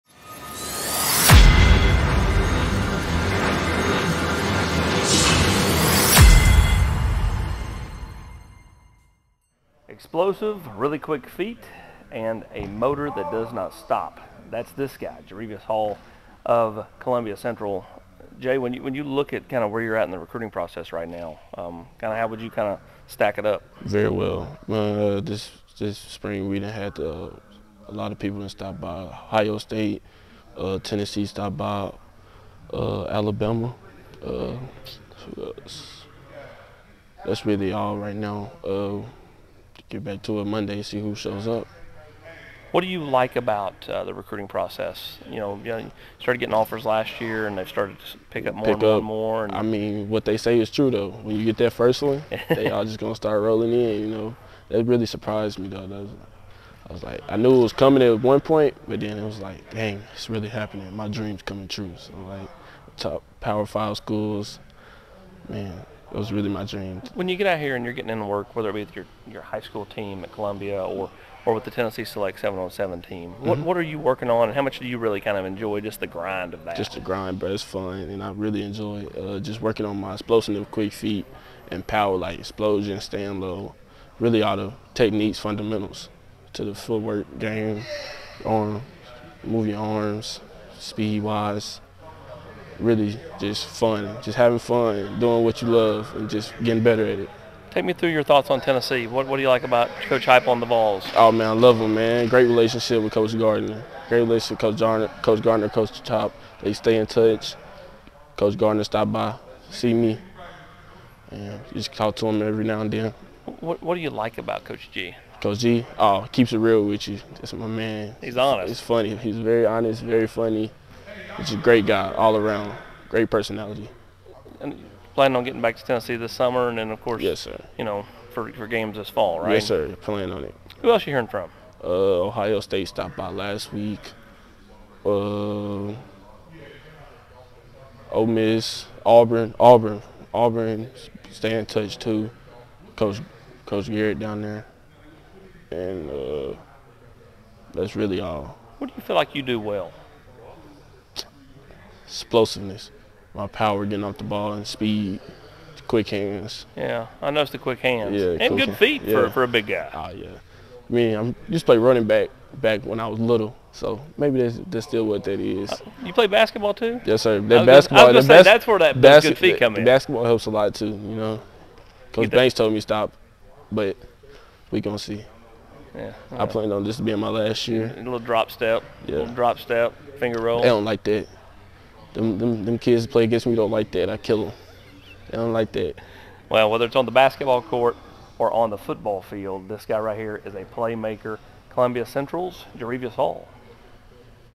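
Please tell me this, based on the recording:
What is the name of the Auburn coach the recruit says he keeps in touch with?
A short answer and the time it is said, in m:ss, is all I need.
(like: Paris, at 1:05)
Coach Garrett, at 2:23.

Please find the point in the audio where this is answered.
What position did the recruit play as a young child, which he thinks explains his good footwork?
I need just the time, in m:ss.
2:41.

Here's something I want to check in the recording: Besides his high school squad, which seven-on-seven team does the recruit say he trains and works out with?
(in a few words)
Tennessee Select.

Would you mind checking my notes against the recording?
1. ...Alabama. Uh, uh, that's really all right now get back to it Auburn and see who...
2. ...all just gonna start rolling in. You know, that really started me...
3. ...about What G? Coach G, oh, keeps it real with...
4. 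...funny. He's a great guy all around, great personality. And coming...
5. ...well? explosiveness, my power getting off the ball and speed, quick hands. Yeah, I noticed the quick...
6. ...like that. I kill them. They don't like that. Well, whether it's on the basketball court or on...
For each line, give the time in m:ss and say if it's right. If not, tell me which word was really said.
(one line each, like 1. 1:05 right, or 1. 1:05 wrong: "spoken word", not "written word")
1. 0:33 wrong: "Monday", not "Auburn"
2. 0:52 wrong: "surprised", not "started"
3. 1:54 wrong: "Coach", not "What"
4. 2:00 wrong: "planning", not "coming"
5. 2:29 right
6. 3:03 right.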